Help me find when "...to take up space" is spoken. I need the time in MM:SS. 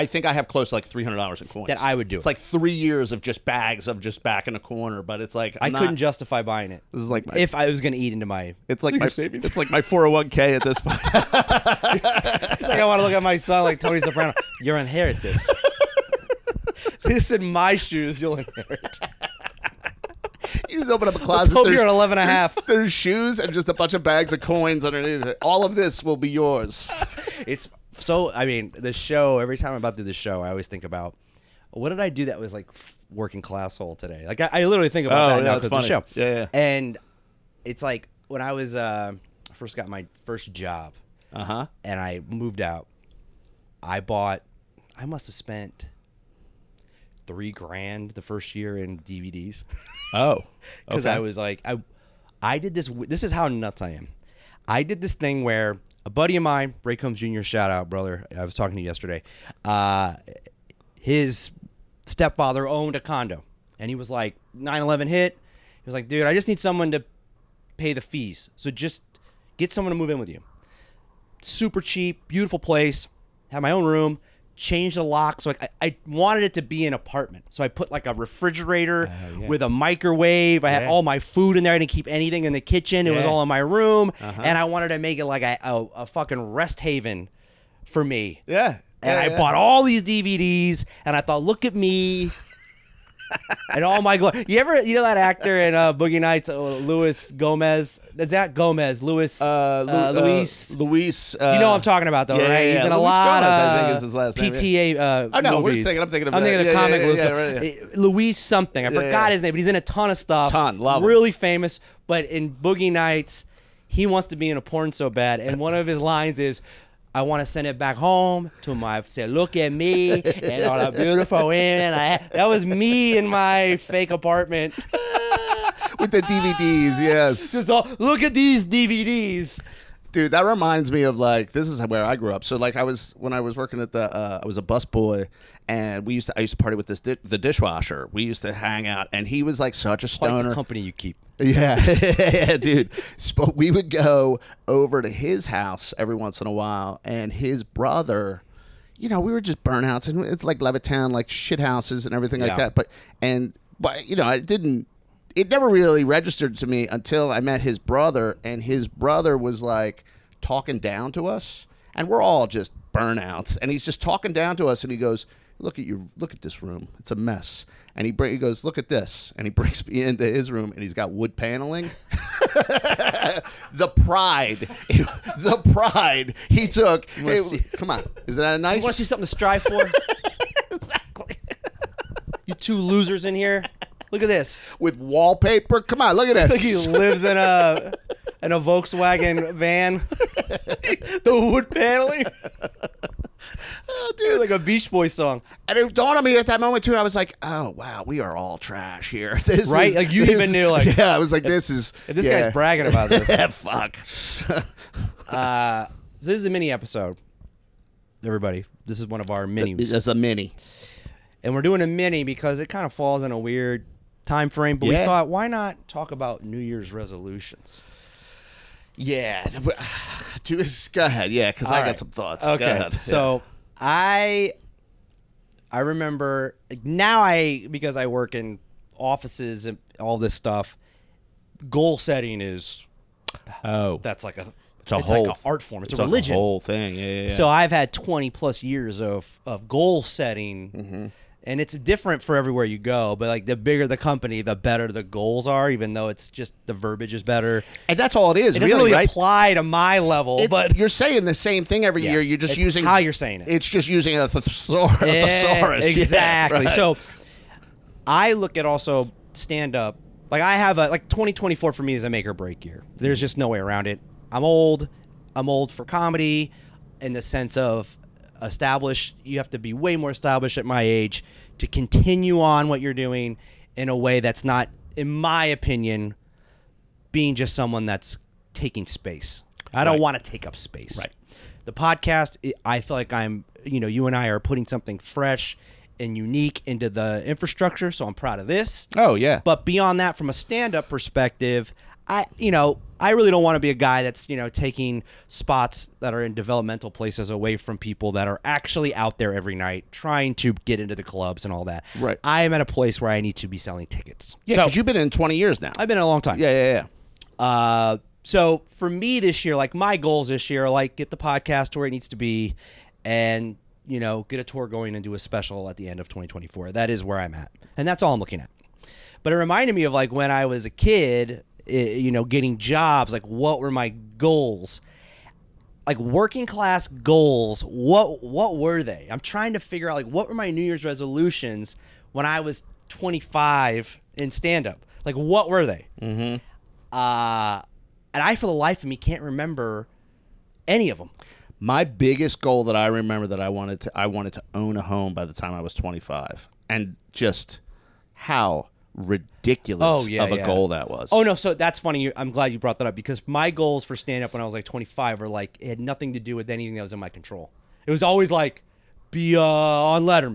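04:40.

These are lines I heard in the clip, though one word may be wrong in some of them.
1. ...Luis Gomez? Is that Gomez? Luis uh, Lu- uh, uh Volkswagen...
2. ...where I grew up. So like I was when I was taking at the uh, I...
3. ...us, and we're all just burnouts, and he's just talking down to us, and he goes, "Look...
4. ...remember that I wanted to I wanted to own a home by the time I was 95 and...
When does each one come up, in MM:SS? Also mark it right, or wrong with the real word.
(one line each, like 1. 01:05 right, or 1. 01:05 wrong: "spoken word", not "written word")
1. 01:36 wrong: "Luis", not "Volkswagen"
2. 02:11 wrong: "working", not "taking"
3. 02:41 right
4. 05:42 wrong: "25", not "95".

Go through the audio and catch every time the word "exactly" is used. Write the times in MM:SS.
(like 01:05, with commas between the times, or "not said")
03:00, 04:15.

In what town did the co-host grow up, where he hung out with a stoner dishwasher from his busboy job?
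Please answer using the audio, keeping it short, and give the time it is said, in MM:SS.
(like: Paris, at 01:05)
Levittown, at 02:30.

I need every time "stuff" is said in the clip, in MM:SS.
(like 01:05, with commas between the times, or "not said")
01:50, 03:50.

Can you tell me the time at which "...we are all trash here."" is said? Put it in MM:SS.
03:18.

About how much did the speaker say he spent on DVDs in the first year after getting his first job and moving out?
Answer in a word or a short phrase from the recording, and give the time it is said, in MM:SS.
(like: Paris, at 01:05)
3 grand, at 00:47.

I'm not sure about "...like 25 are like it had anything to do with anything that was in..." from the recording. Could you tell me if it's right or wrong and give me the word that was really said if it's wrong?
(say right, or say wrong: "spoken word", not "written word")
wrong: "nothing", not "anything".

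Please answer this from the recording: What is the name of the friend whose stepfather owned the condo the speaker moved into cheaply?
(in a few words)
Ray Combs Jr.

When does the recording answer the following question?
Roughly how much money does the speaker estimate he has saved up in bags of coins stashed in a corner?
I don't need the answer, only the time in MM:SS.
00:00.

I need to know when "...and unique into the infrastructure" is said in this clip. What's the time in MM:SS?
04:45.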